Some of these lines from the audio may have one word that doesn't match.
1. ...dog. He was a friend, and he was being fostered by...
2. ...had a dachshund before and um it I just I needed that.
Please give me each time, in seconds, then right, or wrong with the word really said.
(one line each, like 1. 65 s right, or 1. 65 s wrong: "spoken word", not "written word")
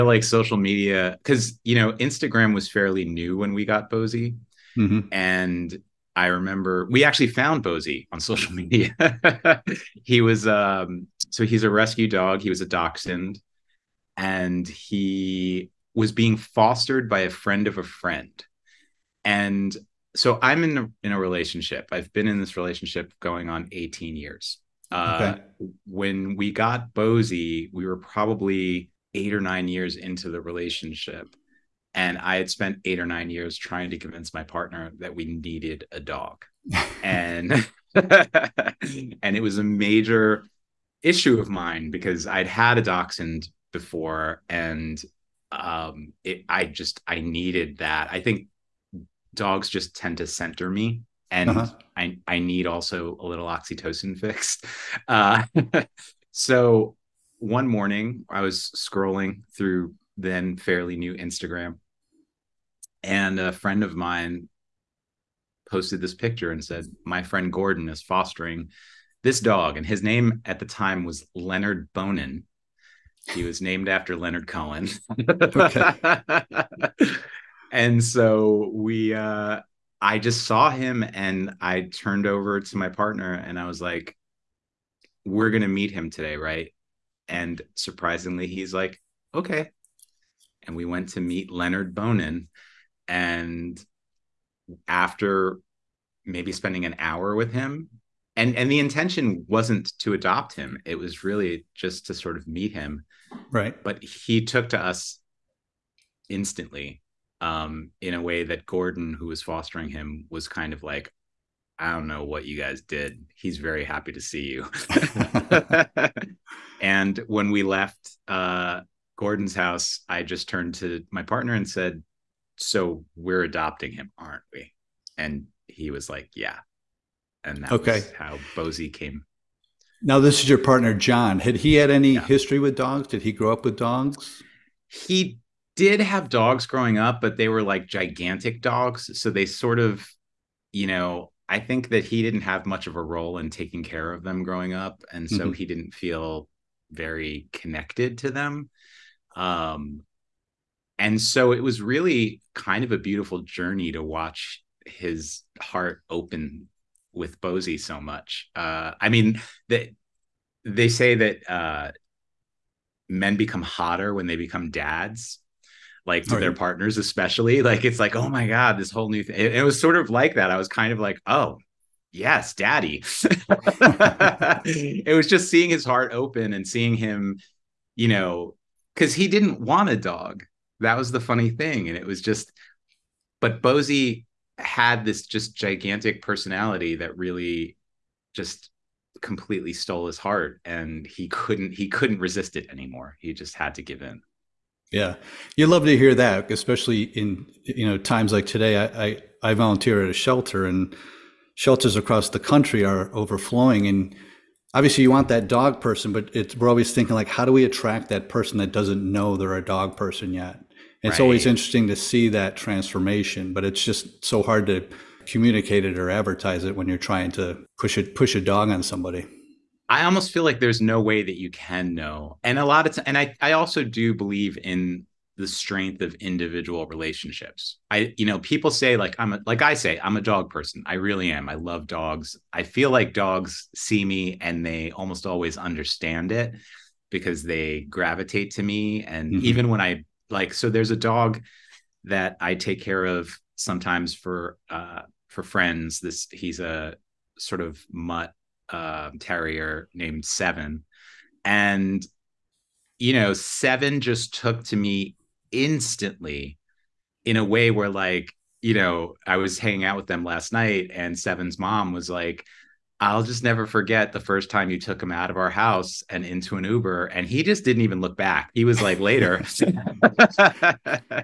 1. 12 s wrong: "dachshund", not "friend"
2. 42 s right.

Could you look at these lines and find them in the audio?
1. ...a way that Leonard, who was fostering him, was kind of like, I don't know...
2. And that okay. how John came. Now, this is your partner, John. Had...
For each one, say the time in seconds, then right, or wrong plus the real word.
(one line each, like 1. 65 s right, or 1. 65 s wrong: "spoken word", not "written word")
1. 108 s wrong: "Gordon", not "Leonard"
2. 127 s wrong: "Bosie", not "John".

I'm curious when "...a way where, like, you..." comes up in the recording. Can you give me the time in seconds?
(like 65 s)
257 s.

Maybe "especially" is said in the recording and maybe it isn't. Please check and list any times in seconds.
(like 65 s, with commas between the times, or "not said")
166 s, 196 s.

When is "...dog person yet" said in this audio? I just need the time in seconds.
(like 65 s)
209 s.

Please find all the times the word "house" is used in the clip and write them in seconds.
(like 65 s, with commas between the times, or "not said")
119 s, 265 s.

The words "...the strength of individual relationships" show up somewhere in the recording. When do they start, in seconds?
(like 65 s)
225 s.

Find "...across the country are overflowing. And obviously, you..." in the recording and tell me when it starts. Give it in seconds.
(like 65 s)
201 s.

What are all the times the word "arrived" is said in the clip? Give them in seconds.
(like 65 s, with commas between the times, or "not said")
not said.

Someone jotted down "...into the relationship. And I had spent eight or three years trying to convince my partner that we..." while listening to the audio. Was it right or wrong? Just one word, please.
wrong.